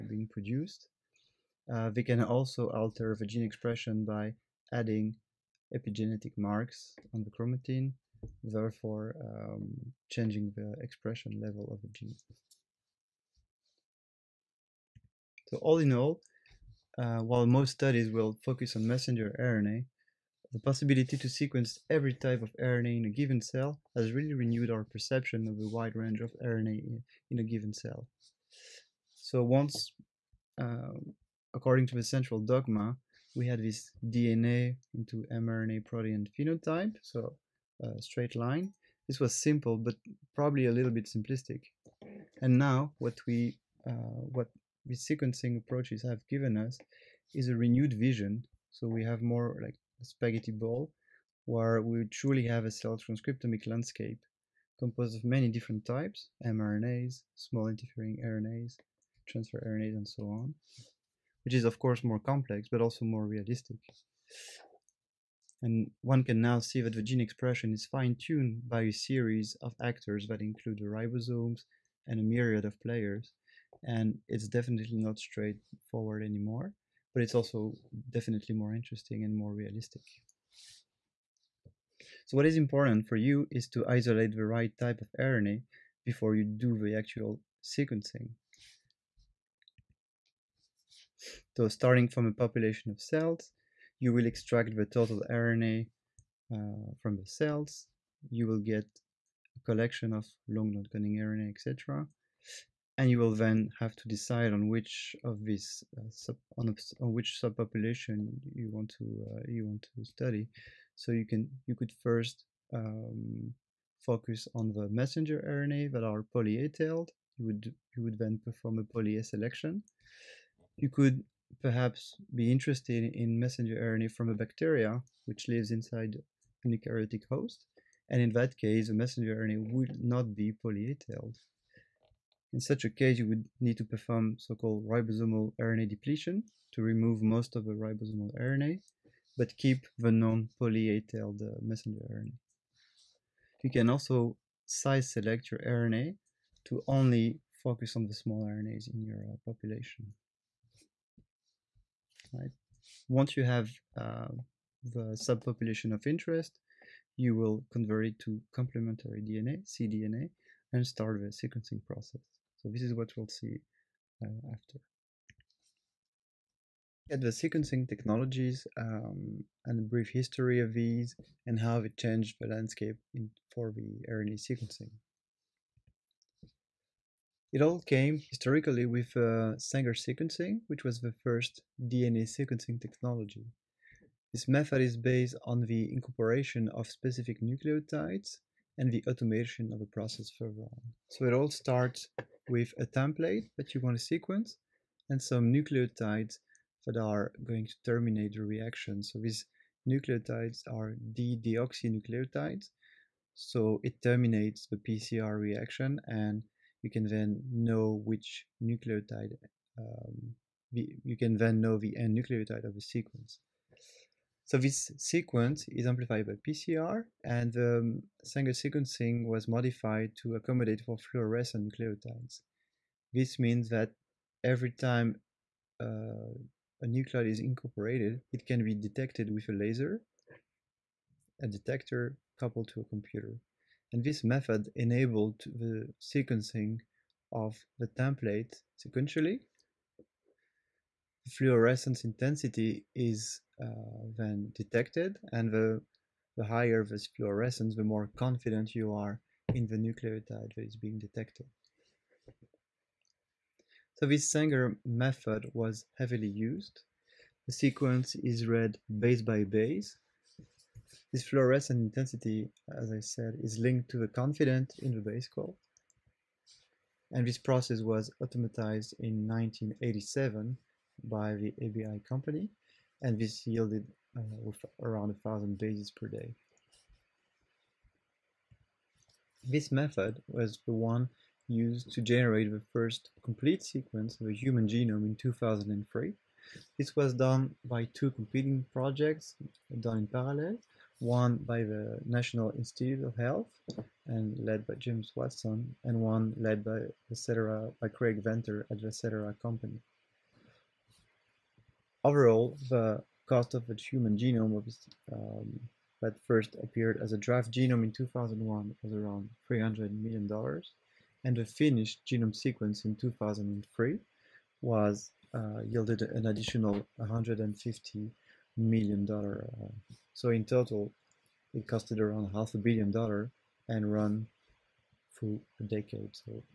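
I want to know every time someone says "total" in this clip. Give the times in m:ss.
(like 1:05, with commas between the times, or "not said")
1:34, 5:20.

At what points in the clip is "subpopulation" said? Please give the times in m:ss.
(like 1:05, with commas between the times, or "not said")
1:47, 2:35.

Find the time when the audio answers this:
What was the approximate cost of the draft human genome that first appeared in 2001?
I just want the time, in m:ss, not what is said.
5:09.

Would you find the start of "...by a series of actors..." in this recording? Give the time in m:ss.
1:08.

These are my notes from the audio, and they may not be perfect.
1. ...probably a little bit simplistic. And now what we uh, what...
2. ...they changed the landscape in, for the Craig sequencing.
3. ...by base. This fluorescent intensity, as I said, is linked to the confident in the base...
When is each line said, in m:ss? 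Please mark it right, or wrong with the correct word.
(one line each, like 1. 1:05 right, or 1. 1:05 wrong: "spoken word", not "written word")
1. 0:40 right
2. 2:51 wrong: "RNA", not "Craig"
3. 4:19 right.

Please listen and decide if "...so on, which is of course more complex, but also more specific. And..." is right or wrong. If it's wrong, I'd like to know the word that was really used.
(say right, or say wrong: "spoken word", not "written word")
wrong: "realistic", not "specific".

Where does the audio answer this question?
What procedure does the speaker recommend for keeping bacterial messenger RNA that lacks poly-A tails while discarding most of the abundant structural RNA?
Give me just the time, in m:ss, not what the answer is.
2:14.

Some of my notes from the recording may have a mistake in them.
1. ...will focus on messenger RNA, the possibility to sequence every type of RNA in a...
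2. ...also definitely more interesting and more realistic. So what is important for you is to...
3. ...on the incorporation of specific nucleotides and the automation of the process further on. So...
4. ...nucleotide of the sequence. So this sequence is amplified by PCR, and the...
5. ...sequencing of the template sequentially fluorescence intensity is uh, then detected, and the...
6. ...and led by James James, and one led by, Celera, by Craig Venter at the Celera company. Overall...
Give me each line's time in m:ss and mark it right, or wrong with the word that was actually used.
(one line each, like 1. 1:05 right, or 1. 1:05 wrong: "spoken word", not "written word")
1. 0:18 right
2. 1:17 right
3. 3:05 right
4. 3:32 right
5. 3:55 right
6. 4:54 wrong: "Watson", not "James".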